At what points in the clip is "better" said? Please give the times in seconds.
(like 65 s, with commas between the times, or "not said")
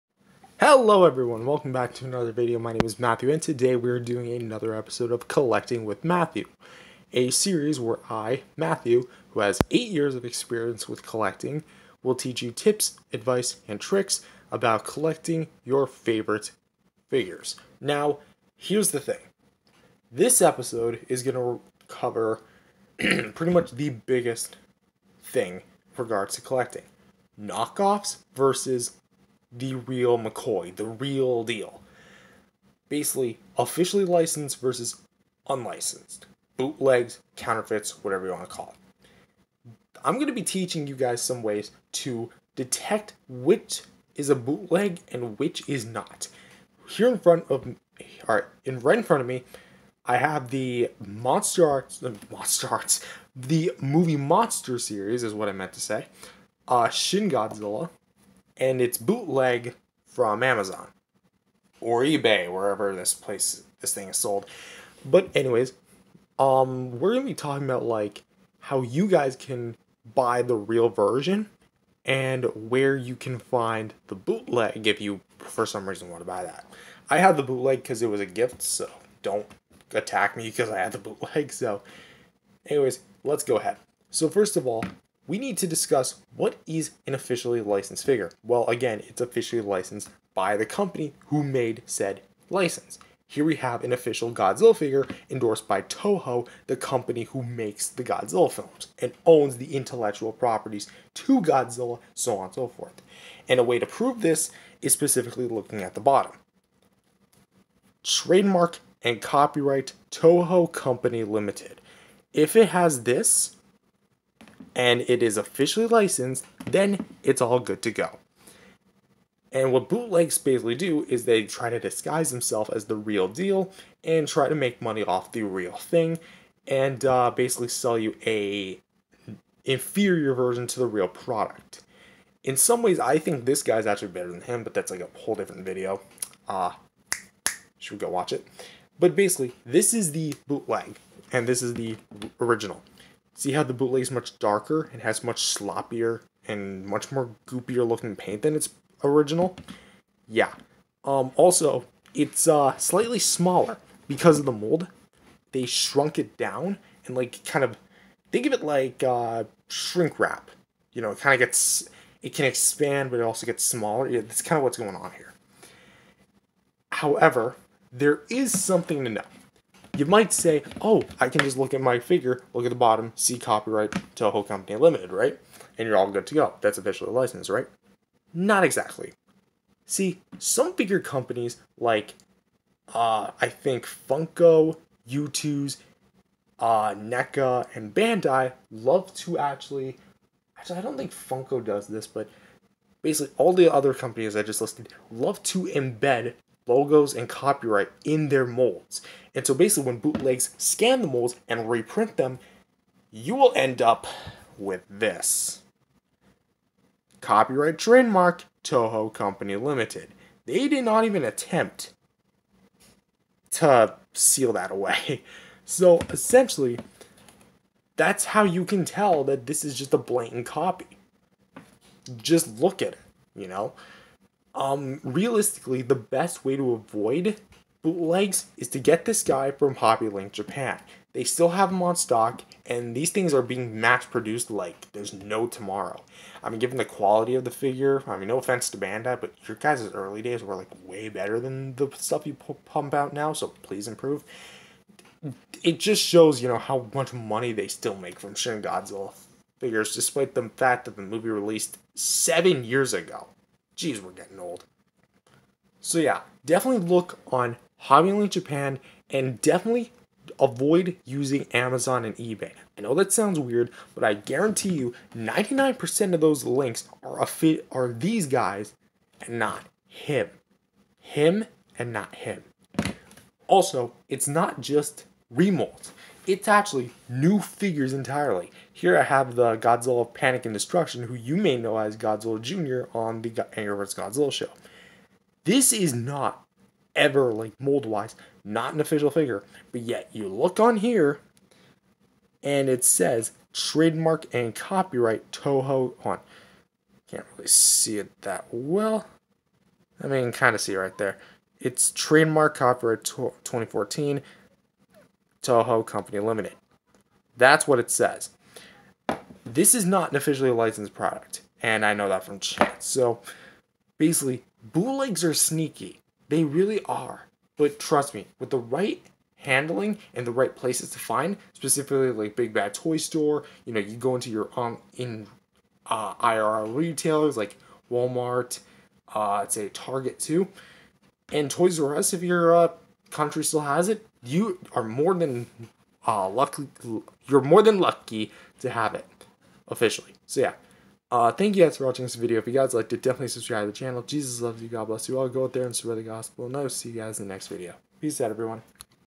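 134 s, 241 s.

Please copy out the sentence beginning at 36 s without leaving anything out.
Bootlegs, counterfeits, whatever you want to call it.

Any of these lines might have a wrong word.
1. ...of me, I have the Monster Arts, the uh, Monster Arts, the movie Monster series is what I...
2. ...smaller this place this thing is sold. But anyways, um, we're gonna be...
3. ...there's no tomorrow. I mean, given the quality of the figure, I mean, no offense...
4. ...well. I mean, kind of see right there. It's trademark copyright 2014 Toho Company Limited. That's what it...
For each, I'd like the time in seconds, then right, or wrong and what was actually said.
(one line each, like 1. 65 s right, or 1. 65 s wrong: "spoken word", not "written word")
1. 49 s right
2. 62 s wrong: "wherever", not "smaller"
3. 234 s right
4. 298 s right.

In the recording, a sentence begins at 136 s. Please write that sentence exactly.
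Uh, should we go watch it?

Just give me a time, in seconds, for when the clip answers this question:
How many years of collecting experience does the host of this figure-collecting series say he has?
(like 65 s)
9 s.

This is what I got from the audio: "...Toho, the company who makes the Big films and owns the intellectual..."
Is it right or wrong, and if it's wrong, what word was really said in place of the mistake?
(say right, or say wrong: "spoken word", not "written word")
wrong: "Godzilla", not "Big".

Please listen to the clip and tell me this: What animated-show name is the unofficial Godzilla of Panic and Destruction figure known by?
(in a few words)
Godzilla Jr.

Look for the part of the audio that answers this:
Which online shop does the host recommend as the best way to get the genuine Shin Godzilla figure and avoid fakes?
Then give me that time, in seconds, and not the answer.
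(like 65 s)
229 s.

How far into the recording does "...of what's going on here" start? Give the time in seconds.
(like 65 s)
164 s.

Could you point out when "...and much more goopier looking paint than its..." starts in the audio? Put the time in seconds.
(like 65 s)
146 s.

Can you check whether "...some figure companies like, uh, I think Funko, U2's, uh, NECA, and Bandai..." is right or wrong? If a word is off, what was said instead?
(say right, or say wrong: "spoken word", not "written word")
right.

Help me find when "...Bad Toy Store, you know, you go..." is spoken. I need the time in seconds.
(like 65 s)
322 s.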